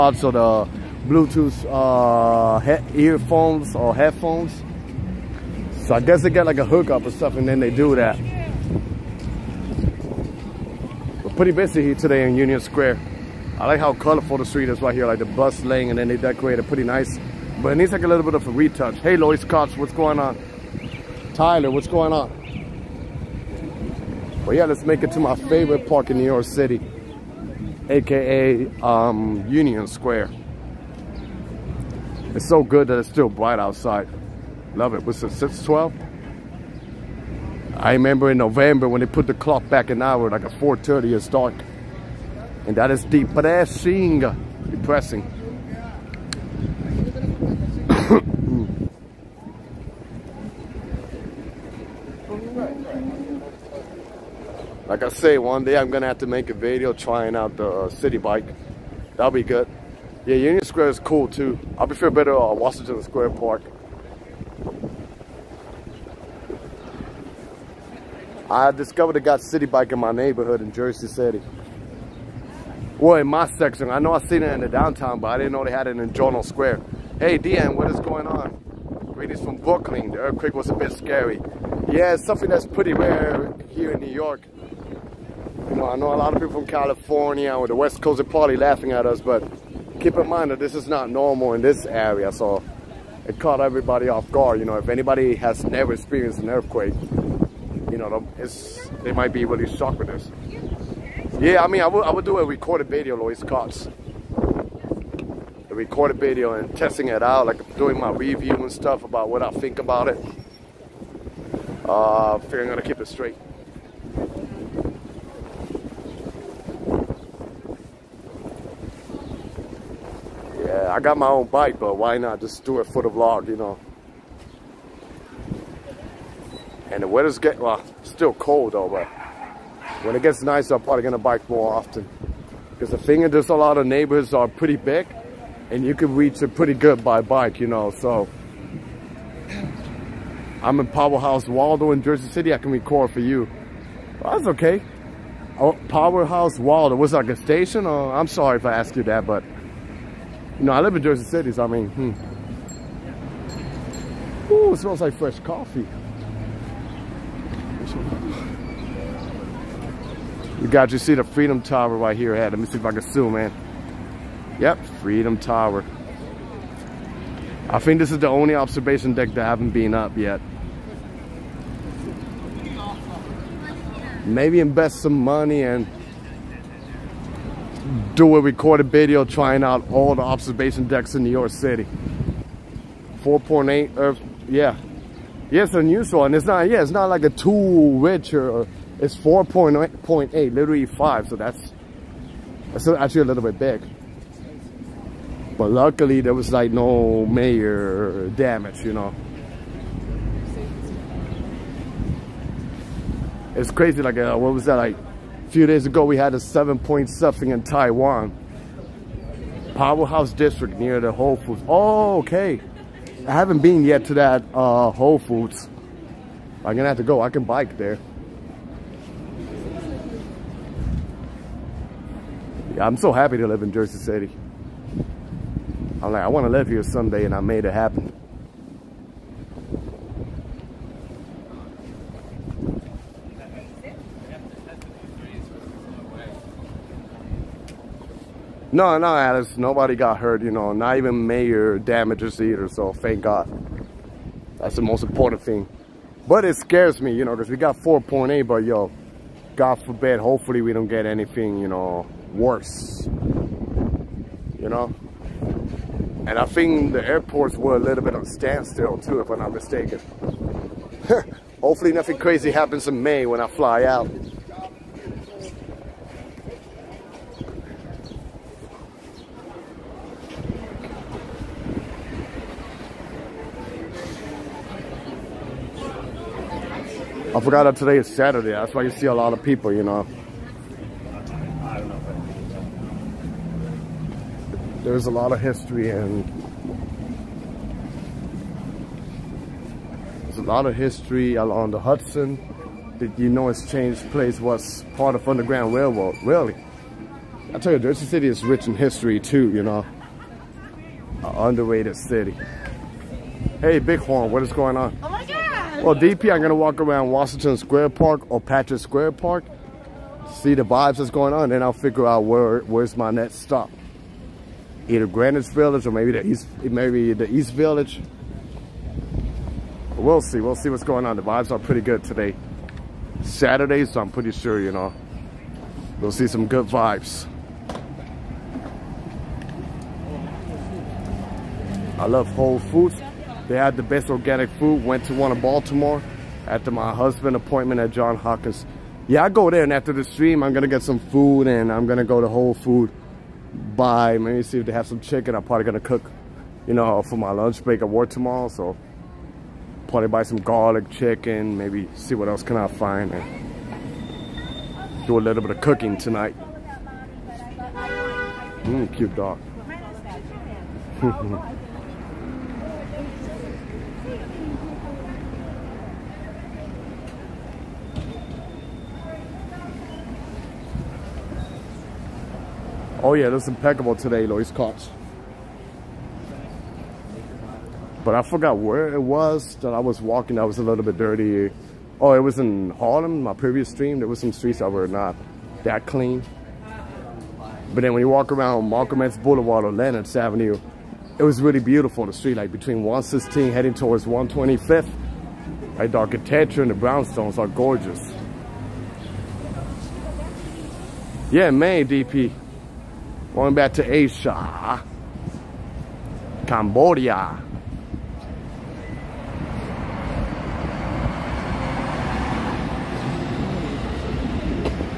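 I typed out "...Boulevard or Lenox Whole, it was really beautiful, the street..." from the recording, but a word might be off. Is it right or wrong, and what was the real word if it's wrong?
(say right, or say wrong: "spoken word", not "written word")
wrong: "Avenue", not "Whole".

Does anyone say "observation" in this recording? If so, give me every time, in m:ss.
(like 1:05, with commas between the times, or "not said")
2:48, 3:00.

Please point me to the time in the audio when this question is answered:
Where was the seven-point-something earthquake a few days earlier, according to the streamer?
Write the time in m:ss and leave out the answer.
3:27.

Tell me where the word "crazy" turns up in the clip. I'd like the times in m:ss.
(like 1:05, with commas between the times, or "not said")
3:23, 4:22.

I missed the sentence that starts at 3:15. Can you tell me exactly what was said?
But luckily, there was like no major damage, you know.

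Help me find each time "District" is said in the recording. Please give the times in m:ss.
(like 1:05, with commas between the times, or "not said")
3:30.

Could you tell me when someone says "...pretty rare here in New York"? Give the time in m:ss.
1:22.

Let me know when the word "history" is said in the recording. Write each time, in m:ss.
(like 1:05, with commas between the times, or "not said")
4:45, 4:50, 4:58.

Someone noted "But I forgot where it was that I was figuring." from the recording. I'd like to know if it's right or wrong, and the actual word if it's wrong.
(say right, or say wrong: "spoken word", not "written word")
wrong: "walking", not "figuring".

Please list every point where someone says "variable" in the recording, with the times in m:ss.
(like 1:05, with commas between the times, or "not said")
not said.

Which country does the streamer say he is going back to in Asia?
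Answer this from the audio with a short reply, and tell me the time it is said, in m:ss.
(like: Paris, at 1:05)
Cambodia, at 6:46.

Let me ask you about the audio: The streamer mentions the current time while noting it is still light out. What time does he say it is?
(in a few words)
6:12.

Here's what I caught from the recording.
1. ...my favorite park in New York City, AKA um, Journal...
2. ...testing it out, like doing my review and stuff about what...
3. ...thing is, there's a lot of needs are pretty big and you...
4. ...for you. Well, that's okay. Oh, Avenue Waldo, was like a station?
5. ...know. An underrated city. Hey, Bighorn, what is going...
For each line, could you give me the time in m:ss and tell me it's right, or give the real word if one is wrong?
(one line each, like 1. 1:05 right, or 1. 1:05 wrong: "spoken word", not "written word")
1. 0:25 wrong: "Union", not "Journal"
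2. 1:46 right
3. 2:12 wrong: "neighborhoods", not "needs"
4. 2:23 wrong: "Powerhouse", not "Avenue"
5. 4:59 right.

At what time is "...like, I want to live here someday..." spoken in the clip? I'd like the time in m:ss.
3:46.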